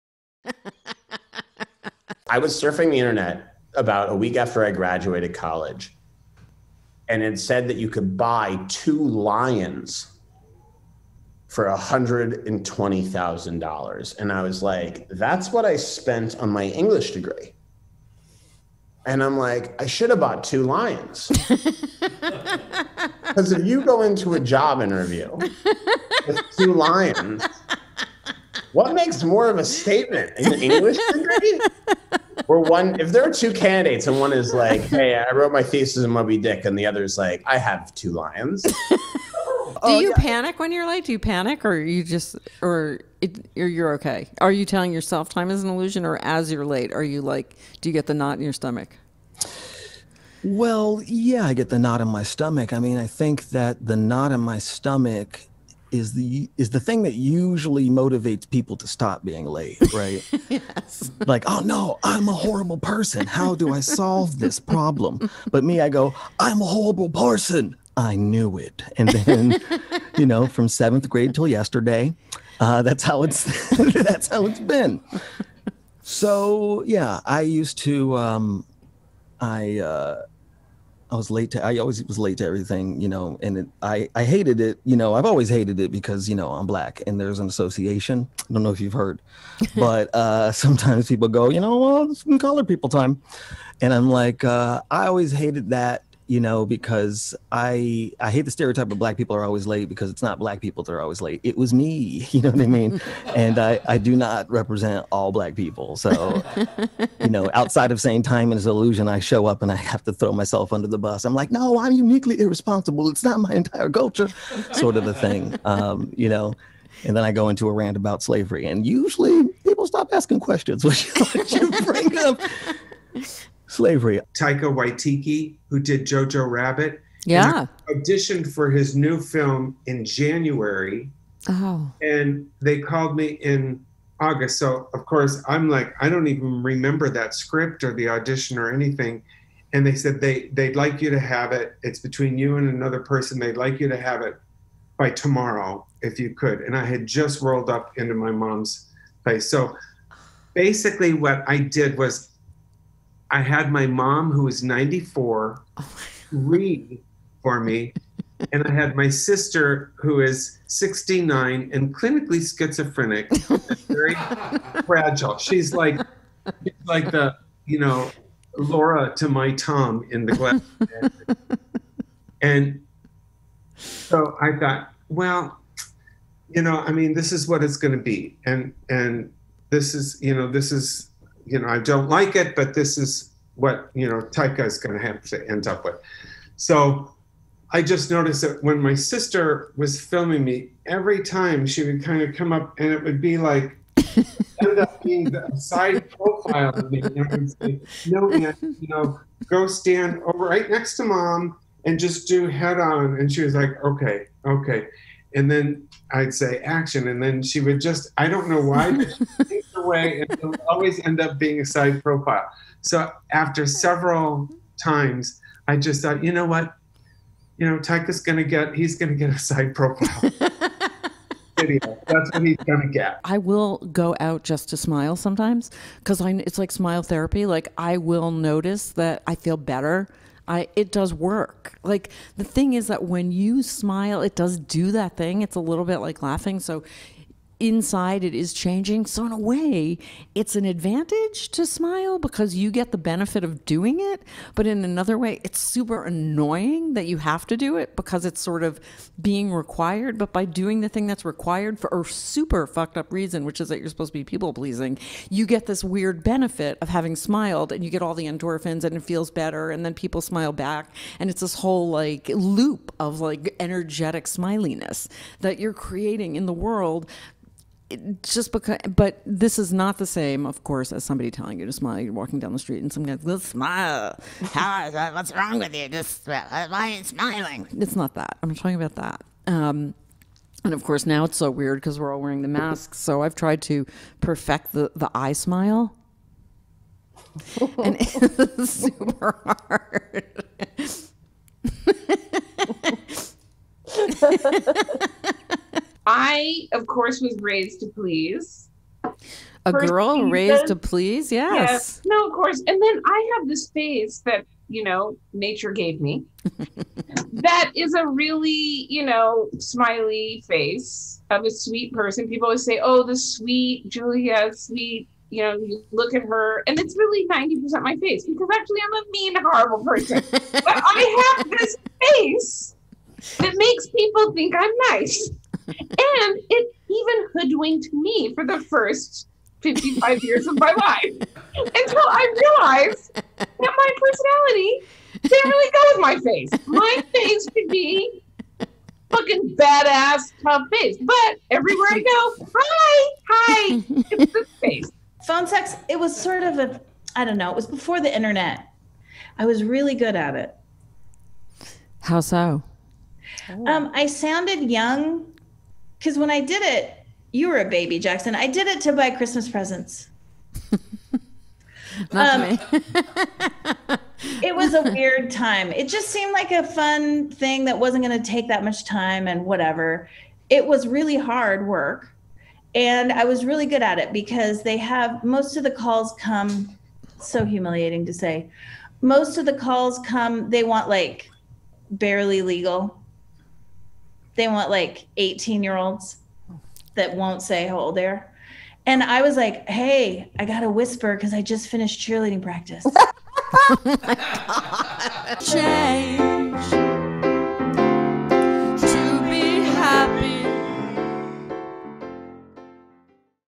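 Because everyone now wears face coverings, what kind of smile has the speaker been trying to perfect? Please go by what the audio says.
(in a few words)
eye smile.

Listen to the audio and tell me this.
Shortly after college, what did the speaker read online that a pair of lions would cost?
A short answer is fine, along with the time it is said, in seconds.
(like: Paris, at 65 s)
$120,000, at 11 s.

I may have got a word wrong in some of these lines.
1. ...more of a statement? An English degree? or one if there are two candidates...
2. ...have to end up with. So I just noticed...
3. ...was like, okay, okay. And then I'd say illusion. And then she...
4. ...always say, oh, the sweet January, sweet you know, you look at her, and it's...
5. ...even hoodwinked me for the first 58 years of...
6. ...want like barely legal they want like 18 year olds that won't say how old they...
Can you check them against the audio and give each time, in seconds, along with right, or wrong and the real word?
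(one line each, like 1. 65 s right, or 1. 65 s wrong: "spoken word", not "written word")
1. 29 s right
2. 185 s right
3. 203 s wrong: "action", not "illusion"
4. 312 s wrong: "Julia", not "January"
5. 326 s wrong: "55", not "58"
6. 380 s right.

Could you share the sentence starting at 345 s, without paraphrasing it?
Phone sex, it was sort of a, I don't know, it was before the internet.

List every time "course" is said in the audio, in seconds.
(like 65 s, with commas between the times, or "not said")
135 s, 270 s, 280 s, 296 s, 302 s.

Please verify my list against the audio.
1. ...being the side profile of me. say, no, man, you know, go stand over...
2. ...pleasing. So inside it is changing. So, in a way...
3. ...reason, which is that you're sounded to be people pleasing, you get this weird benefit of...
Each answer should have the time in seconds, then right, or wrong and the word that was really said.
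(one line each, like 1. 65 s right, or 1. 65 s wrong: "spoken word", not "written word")
1. 195 s right
2. 236 s wrong: "laughing", not "pleasing"
3. 253 s wrong: "supposed", not "sounded".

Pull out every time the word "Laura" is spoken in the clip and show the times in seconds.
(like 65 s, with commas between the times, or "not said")
168 s.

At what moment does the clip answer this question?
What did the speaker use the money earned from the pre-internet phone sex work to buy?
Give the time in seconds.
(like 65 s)
359 s.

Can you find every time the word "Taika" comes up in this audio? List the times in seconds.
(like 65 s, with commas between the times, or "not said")
124 s, 184 s, 217 s.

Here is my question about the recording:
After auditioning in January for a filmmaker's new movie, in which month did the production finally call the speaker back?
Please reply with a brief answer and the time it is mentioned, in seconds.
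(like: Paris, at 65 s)
August, at 134 s.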